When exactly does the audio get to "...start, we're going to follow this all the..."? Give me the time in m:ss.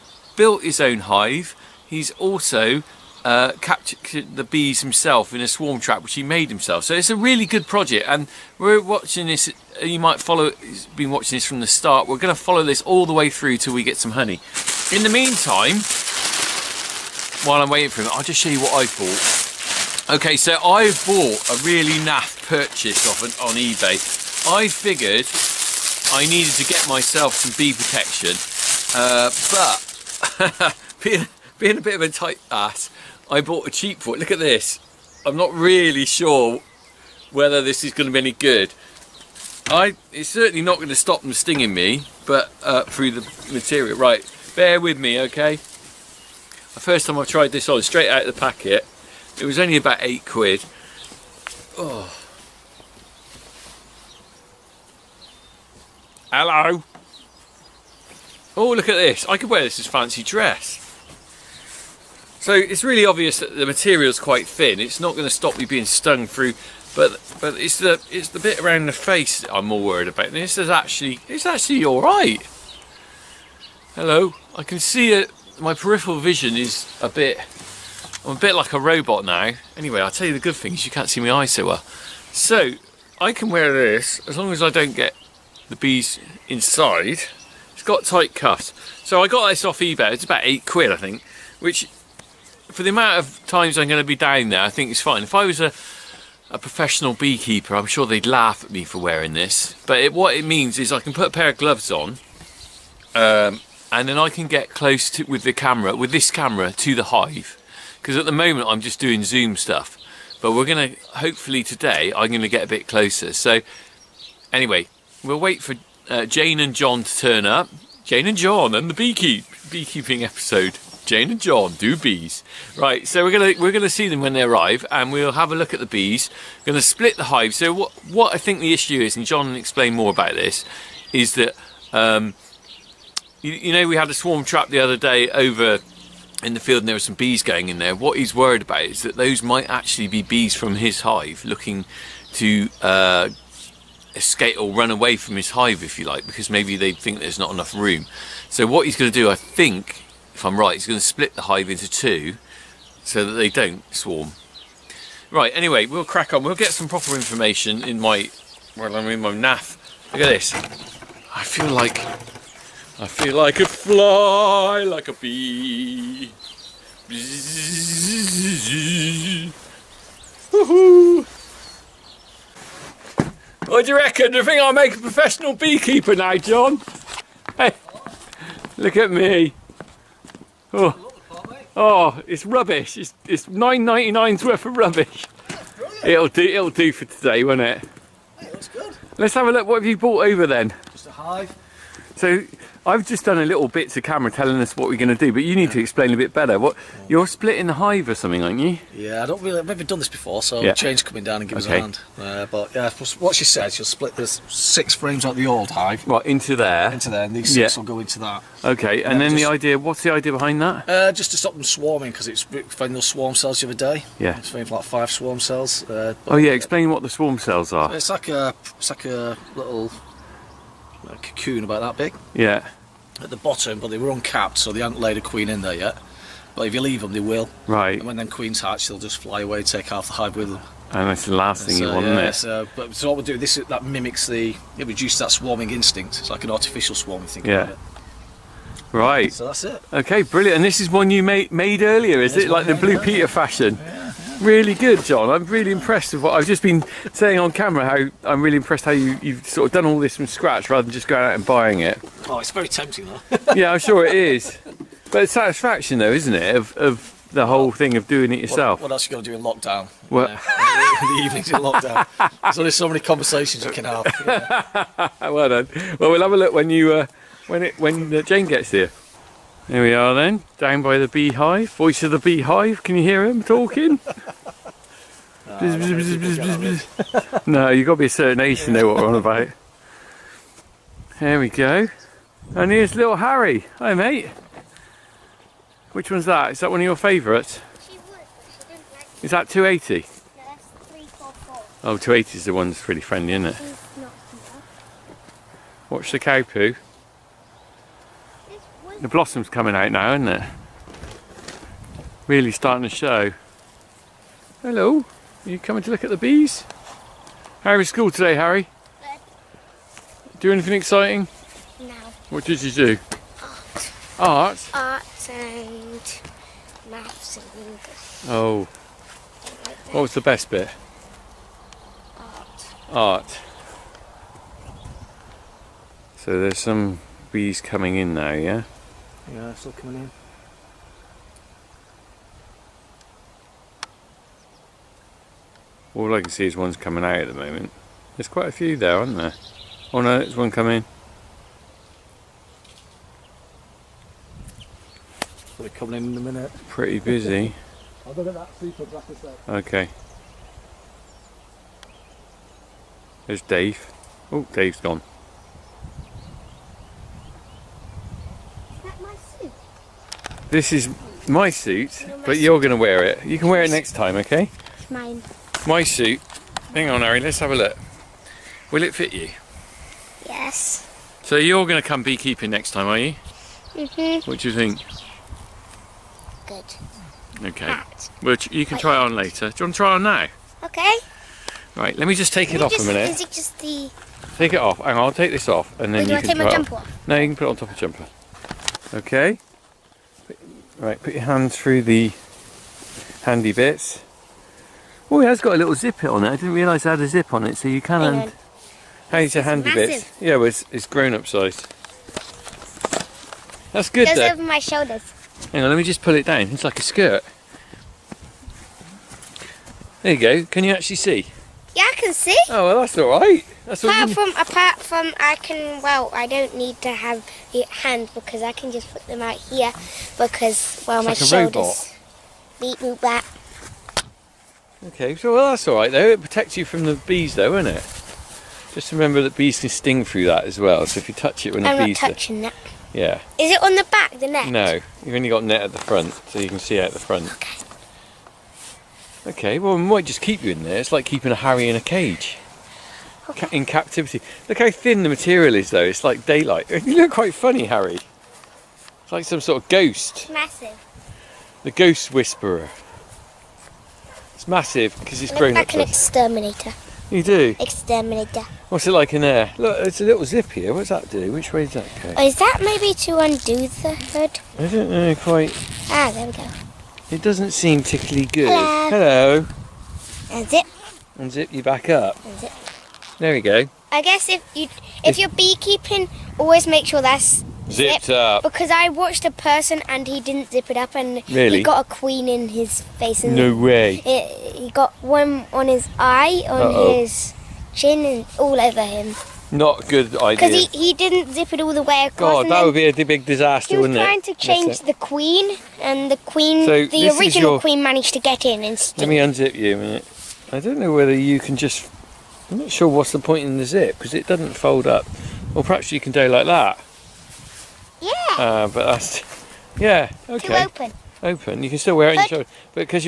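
0:11.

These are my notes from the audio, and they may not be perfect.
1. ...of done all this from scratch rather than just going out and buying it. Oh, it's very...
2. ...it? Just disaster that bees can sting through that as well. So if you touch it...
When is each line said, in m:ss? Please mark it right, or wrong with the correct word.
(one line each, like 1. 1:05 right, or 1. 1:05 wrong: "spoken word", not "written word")
1. 4:09 right
2. 7:07 wrong: "remember", not "disaster".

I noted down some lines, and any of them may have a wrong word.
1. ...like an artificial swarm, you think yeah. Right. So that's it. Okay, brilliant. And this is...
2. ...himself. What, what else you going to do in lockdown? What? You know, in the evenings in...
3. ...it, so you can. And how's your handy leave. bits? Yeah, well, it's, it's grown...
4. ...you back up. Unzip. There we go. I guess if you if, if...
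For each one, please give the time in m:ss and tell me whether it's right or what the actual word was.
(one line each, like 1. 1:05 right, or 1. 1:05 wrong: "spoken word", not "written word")
1. 3:56 right
2. 4:18 wrong: "yourself", not "himself"
3. 6:37 wrong: "massive", not "leave"
4. 7:51 right.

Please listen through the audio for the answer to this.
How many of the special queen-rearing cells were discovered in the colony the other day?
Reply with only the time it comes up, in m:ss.
3:34.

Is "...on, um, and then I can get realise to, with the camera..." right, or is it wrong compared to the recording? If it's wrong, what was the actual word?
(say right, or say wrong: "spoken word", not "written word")
wrong: "close", not "realise".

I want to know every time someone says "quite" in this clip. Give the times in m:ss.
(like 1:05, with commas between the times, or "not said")
1:04, 5:38, 7:27, 7:45.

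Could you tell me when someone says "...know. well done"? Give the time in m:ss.
4:25.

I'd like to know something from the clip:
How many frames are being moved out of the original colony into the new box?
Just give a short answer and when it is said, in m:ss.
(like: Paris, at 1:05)
6, at 3:24.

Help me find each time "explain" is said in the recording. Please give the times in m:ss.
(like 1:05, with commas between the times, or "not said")
2:09, 3:15, 3:36.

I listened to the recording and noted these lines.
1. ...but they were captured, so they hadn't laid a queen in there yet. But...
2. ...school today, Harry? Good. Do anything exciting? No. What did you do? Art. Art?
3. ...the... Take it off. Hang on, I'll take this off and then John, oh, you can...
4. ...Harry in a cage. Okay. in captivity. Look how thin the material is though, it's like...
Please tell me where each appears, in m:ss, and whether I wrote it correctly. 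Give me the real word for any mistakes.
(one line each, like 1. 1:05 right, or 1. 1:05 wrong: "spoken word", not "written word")
1. 3:43 wrong: "uncapped", not "captured"
2. 5:07 right
3. 6:23 wrong: "Wait", not "John"
4. 7:21 right.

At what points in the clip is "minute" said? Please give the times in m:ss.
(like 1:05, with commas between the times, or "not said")
5:46, 6:22, 8:19.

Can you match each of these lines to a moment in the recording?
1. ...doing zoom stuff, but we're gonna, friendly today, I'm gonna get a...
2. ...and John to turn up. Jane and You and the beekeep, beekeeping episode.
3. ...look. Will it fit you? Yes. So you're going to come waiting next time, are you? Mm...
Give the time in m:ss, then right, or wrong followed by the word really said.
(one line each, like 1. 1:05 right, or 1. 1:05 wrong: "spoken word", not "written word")
1. 1:48 wrong: "hopefully", not "friendly"
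2. 1:56 wrong: "John", not "You"
3. 6:07 wrong: "beekeeping", not "waiting".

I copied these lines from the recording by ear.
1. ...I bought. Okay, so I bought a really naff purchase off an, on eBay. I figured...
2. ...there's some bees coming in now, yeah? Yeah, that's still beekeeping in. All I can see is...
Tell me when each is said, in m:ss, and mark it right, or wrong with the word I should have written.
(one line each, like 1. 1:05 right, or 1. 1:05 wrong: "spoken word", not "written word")
1. 0:18 right
2. 5:26 wrong: "coming", not "beekeeping".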